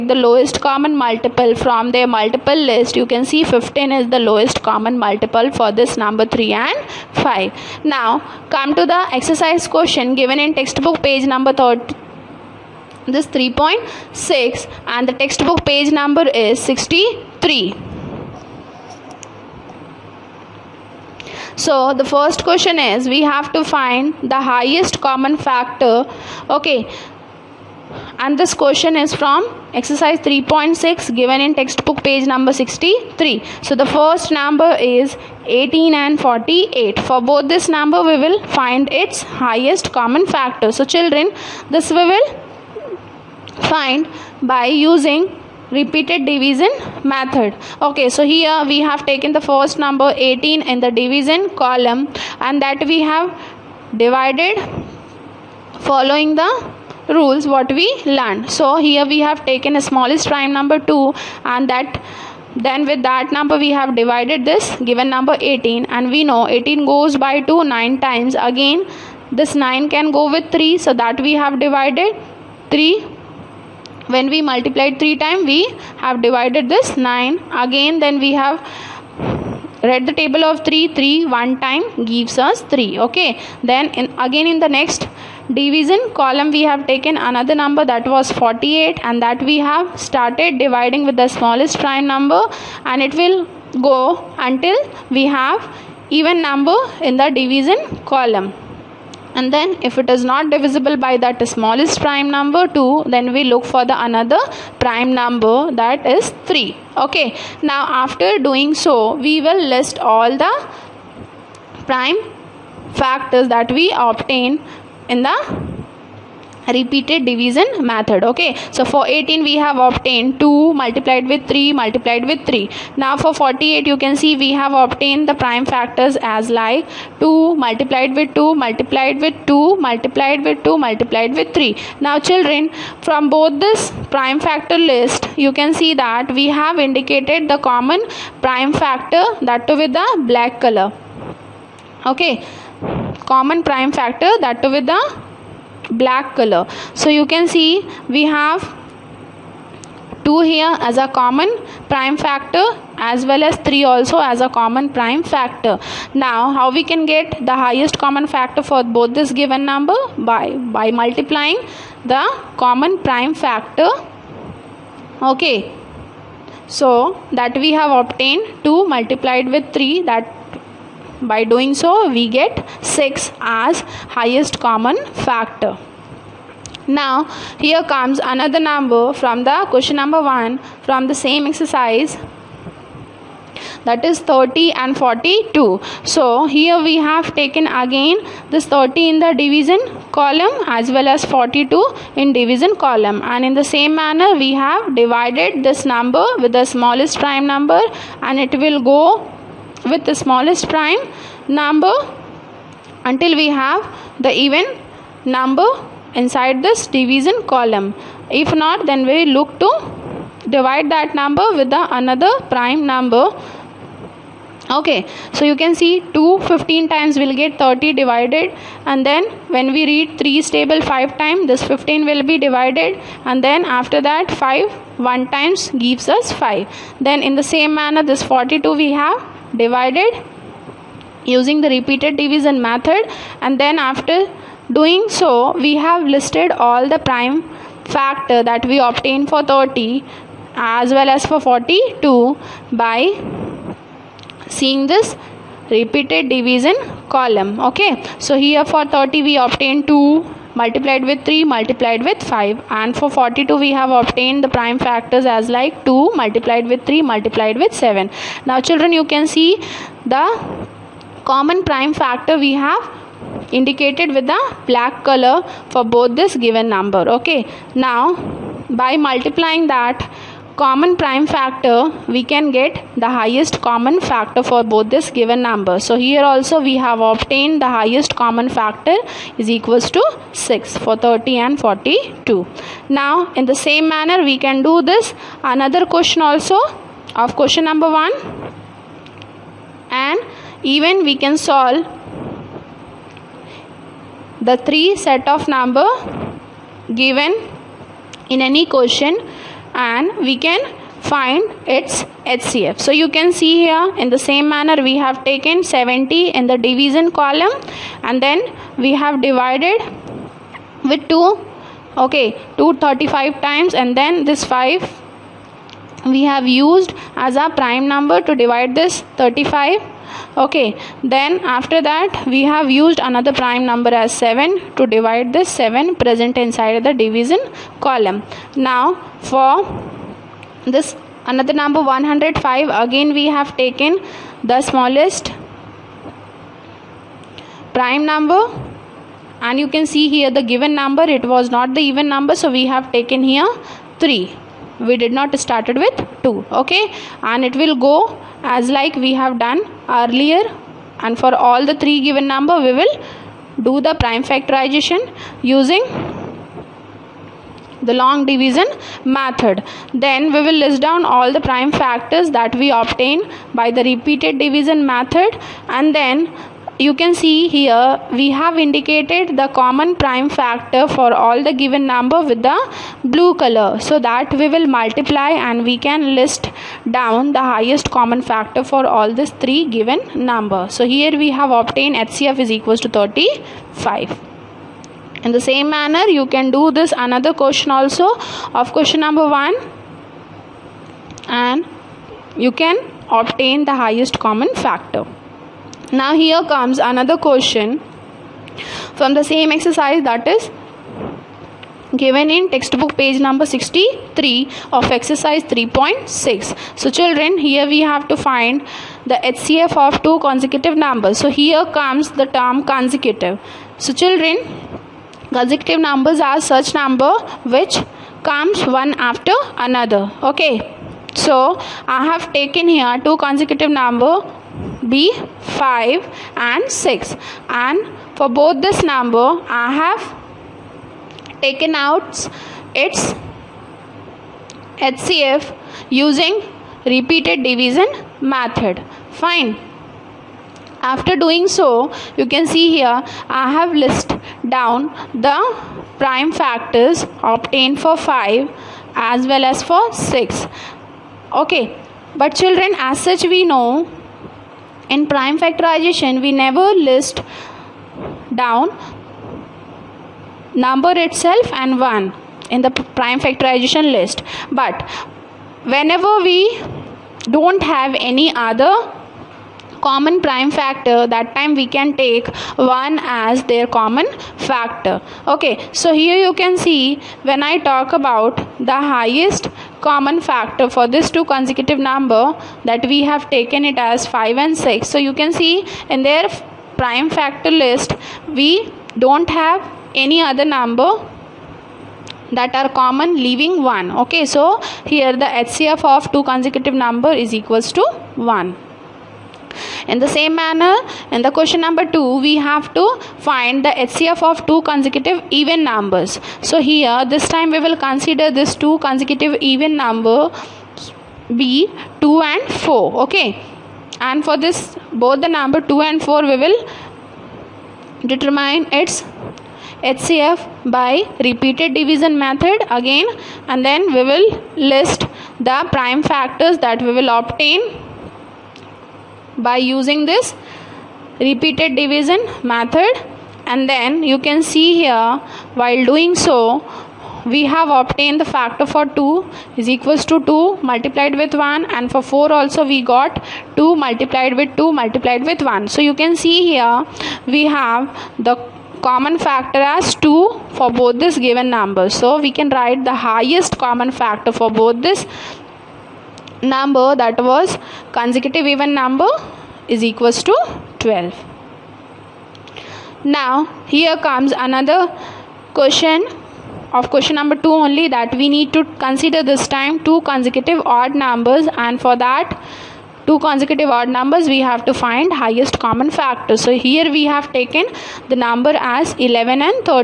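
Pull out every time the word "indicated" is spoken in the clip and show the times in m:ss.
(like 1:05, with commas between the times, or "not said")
2:16, 4:23, 6:08.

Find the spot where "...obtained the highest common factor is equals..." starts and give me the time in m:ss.
4:37.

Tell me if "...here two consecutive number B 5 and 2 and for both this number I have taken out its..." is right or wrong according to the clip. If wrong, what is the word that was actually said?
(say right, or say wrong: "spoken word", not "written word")
wrong: "6", not "2".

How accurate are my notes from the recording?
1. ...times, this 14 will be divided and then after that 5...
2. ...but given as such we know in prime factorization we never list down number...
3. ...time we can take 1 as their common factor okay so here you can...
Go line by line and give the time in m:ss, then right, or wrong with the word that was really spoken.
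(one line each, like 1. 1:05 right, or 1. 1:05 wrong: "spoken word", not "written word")
1. 3:41 wrong: "15", not "14"
2. 7:32 wrong: "children", not "given"
3. 7:51 right.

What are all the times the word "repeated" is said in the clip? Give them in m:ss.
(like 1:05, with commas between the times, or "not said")
0:45, 1:56, 3:51, 4:05, 6:03, 7:16, 8:41, 8:51.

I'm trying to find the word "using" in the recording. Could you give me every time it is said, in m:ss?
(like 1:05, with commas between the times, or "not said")
0:44, 3:51, 5:55, 7:15, 8:49.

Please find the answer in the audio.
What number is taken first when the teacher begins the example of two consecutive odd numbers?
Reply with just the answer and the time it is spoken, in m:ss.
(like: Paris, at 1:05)
11, at 9:38.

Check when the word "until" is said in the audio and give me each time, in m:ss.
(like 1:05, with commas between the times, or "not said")
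1:34, 3:23.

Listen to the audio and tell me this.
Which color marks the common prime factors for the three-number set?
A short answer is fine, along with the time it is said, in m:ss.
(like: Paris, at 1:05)
Blue, at 6:13.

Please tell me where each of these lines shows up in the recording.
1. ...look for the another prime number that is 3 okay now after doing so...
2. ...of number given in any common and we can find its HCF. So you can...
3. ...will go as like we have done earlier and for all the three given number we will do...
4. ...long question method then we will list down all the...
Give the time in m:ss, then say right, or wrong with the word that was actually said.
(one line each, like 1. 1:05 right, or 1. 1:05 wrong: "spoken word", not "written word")
1. 1:43 right
2. 4:55 wrong: "question", not "common"
3. 5:47 right
4. 5:58 wrong: "division", not "question".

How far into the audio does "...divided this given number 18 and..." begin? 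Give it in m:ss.
1:03.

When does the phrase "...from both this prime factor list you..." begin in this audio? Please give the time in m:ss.
2:13.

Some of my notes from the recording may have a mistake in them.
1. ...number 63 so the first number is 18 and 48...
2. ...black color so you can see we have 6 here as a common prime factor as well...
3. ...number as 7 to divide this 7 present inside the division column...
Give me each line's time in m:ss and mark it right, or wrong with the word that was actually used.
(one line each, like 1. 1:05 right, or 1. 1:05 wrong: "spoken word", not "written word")
1. 0:32 right
2. 2:25 wrong: "2", not "6"
3. 5:23 right.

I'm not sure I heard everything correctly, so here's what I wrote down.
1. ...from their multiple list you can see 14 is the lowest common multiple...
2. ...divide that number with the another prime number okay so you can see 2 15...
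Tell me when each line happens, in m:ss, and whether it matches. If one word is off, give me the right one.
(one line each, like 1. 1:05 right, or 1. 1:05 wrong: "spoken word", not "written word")
1. 0:01 wrong: "15", not "14"
2. 3:30 right.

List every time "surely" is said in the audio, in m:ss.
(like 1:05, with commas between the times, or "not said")
not said.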